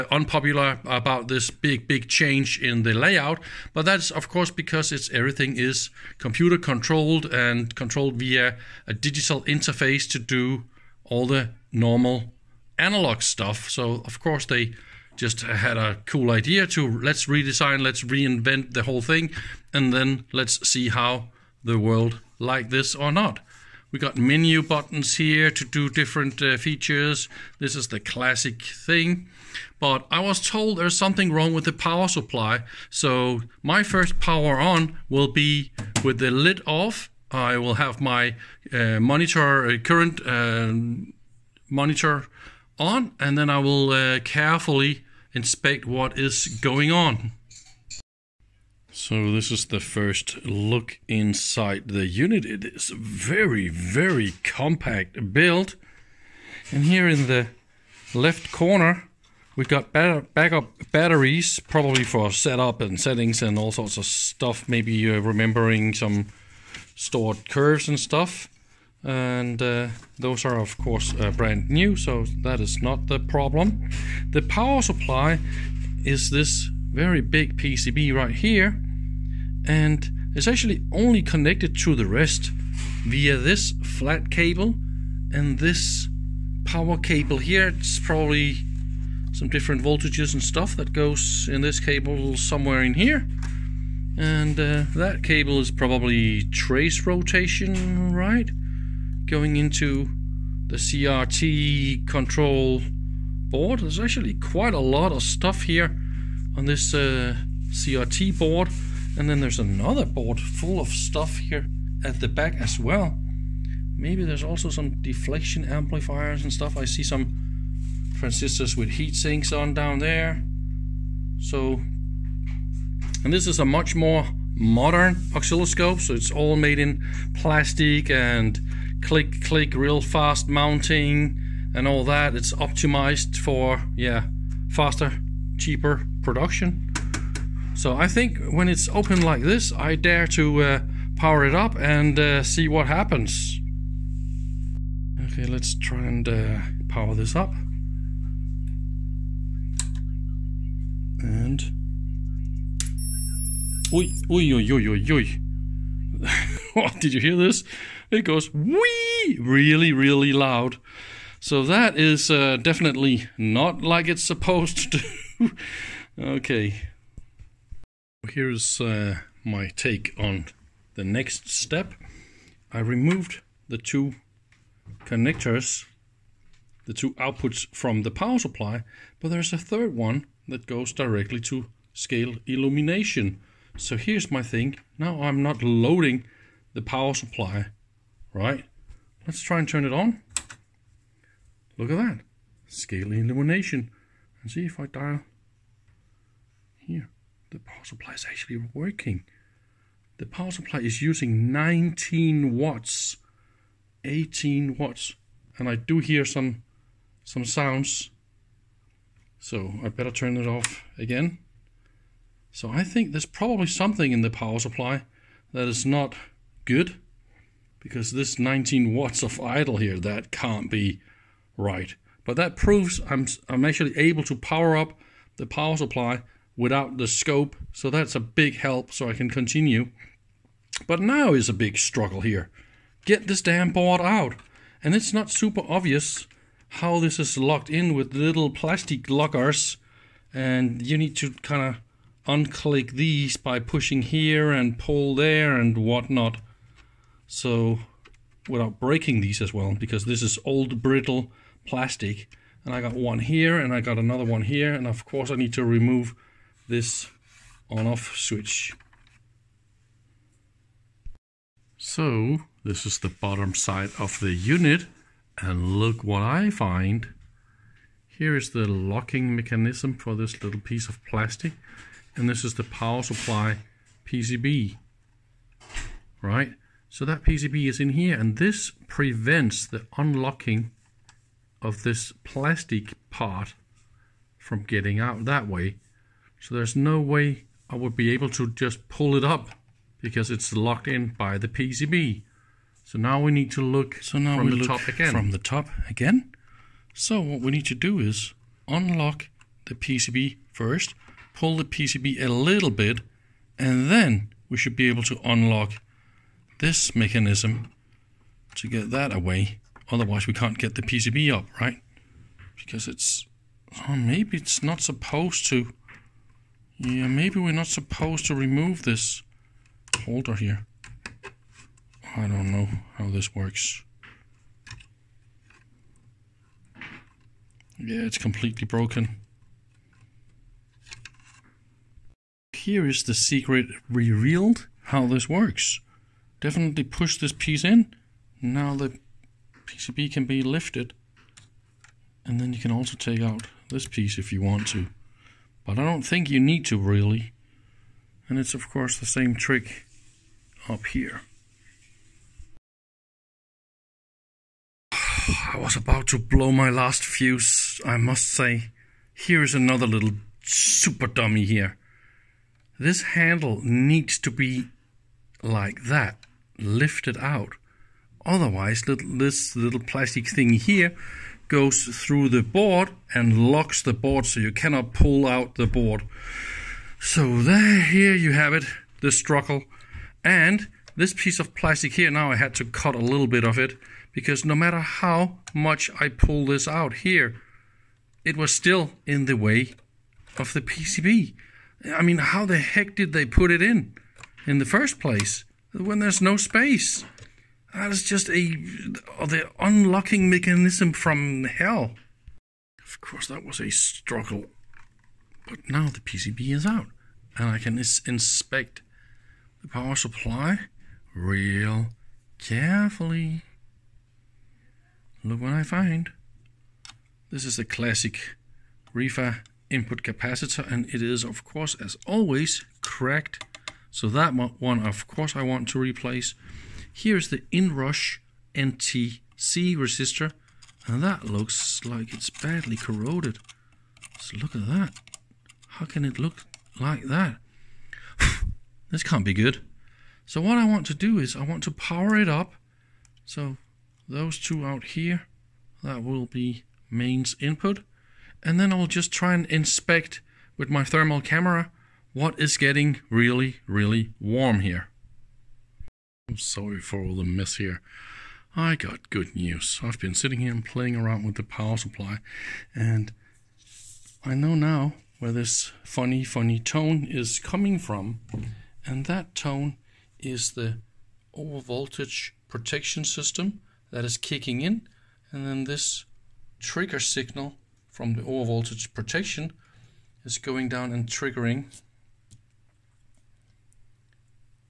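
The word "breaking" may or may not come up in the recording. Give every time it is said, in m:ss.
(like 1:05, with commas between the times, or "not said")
4:08.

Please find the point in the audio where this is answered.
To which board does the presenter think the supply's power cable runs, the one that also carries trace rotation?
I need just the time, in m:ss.
1:40.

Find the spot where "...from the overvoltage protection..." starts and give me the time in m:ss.
7:57.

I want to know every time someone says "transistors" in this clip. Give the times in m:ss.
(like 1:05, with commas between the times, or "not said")
1:58.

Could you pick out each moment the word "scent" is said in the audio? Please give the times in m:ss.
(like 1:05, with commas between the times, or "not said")
not said.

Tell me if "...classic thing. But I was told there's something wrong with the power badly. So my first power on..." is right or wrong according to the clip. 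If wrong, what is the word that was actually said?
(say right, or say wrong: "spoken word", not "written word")
wrong: "supply", not "badly".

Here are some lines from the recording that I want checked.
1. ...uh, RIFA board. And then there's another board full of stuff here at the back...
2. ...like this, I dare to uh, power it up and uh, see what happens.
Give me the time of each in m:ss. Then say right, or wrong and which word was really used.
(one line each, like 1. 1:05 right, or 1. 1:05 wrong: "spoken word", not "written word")
1. 1:46 wrong: "CRT", not "RIFA"
2. 2:19 right.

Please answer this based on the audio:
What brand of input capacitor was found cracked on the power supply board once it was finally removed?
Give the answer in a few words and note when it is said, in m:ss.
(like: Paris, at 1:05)
RIFA, at 6:58.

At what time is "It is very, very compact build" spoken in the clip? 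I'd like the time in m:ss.
0:52.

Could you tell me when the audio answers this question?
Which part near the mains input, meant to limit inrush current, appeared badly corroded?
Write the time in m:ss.
7:08.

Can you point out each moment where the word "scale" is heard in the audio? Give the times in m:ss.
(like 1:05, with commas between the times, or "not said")
3:01, 3:12.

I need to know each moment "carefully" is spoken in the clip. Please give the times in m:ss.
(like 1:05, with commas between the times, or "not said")
0:44, 6:52.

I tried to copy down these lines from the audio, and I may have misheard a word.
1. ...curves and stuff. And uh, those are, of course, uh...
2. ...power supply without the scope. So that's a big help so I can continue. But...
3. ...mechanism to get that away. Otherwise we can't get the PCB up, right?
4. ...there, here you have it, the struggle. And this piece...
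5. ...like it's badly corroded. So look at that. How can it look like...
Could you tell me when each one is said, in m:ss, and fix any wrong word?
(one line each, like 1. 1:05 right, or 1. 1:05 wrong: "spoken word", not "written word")
1. 1:07 right
2. 3:45 right
3. 5:06 right
4. 6:17 right
5. 7:11 right.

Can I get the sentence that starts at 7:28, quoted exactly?
And then I'll just try and inspect with my thermal camera what is getting really, really warm here.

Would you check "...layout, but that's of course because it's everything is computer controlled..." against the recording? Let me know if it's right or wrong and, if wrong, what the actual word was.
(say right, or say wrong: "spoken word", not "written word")
right.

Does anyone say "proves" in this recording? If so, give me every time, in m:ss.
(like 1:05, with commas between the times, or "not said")
3:42.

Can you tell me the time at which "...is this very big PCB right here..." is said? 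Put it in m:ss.
1:16.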